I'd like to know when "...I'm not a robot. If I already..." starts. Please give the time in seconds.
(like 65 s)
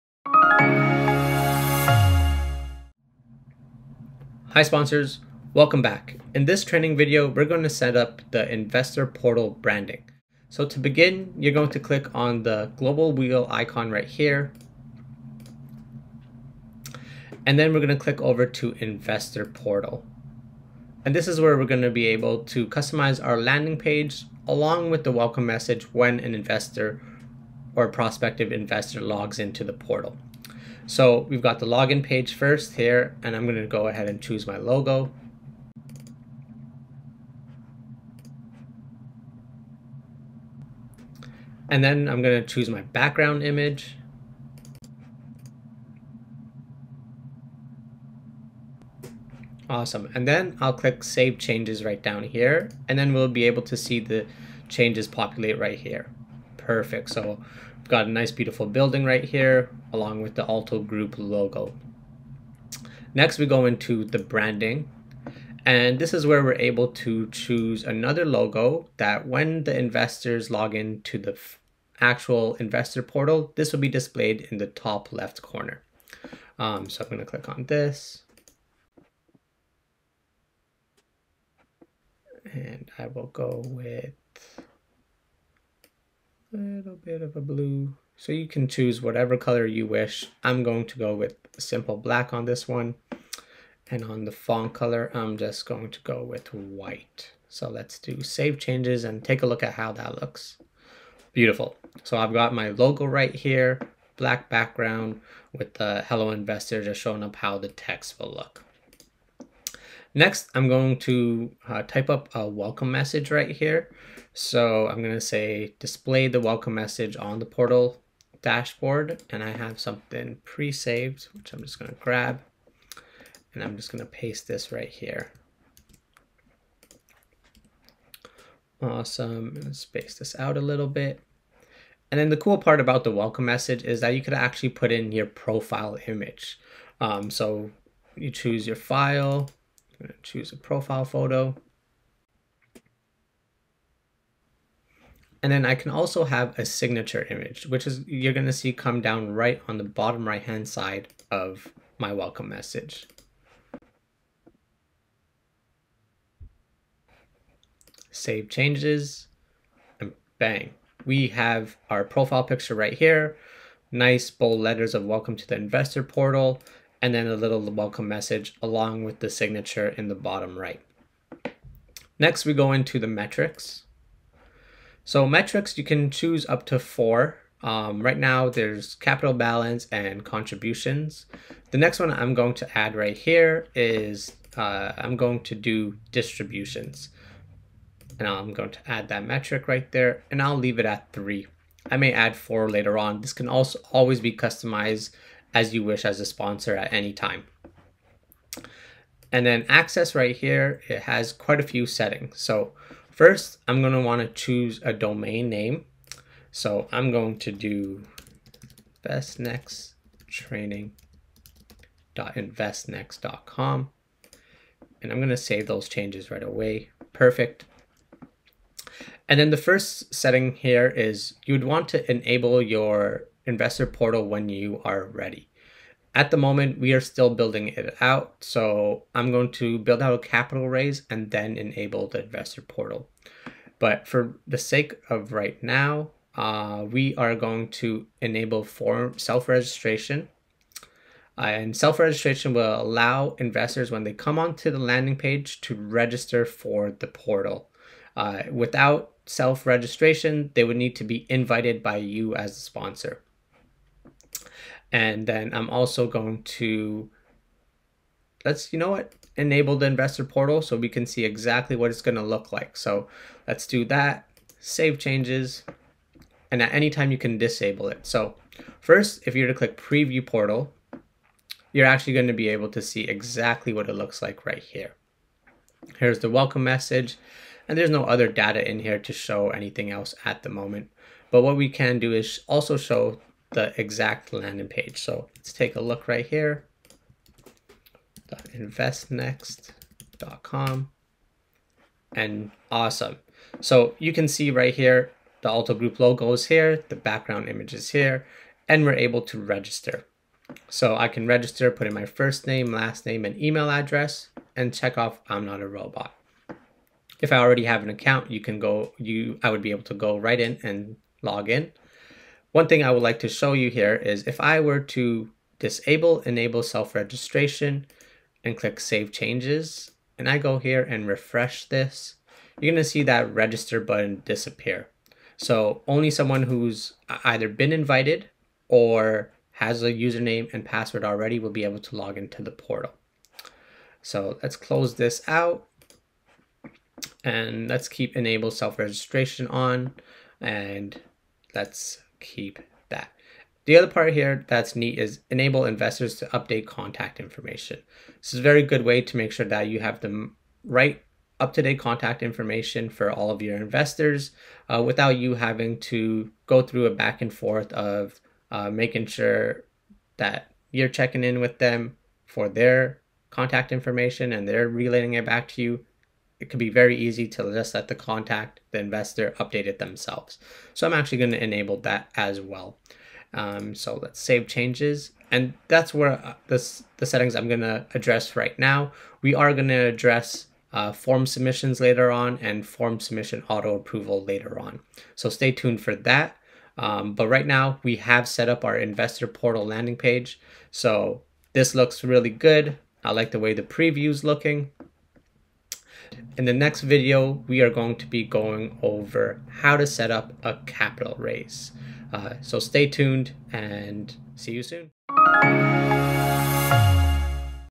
305 s.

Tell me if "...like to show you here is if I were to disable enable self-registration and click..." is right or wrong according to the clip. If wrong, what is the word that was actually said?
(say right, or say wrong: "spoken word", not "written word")
right.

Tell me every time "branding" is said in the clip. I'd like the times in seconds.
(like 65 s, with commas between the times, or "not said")
9 s, 64 s.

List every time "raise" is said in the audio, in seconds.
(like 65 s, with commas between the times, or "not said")
230 s, 401 s.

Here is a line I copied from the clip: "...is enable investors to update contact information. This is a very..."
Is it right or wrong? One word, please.
right.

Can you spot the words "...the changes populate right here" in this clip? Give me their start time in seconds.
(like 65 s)
54 s.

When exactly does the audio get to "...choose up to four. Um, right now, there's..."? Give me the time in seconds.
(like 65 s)
176 s.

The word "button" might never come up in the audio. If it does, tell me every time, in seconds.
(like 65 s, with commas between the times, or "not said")
323 s.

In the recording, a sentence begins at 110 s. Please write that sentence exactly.
Next, I'm going to uh, type up a welcome message right here.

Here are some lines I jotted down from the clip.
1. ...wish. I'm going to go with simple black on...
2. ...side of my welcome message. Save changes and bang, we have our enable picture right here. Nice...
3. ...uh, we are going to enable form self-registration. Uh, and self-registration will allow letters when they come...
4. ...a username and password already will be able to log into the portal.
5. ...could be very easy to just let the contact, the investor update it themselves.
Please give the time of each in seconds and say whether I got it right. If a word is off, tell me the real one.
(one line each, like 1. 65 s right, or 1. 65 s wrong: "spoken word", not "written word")
1. 89 s right
2. 150 s wrong: "profile", not "enable"
3. 236 s wrong: "investors", not "letters"
4. 329 s right
5. 366 s right.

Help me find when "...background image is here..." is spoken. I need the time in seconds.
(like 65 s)
296 s.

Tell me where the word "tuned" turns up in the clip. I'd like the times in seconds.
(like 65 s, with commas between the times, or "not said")
385 s, 402 s.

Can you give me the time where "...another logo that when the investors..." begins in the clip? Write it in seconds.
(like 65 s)
67 s.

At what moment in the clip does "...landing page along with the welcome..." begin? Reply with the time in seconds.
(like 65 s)
23 s.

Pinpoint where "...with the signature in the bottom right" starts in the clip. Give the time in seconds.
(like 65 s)
169 s.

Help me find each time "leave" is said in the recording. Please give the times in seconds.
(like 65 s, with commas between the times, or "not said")
190 s.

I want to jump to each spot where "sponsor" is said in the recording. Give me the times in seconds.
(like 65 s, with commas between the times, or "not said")
4 s, 196 s, 252 s.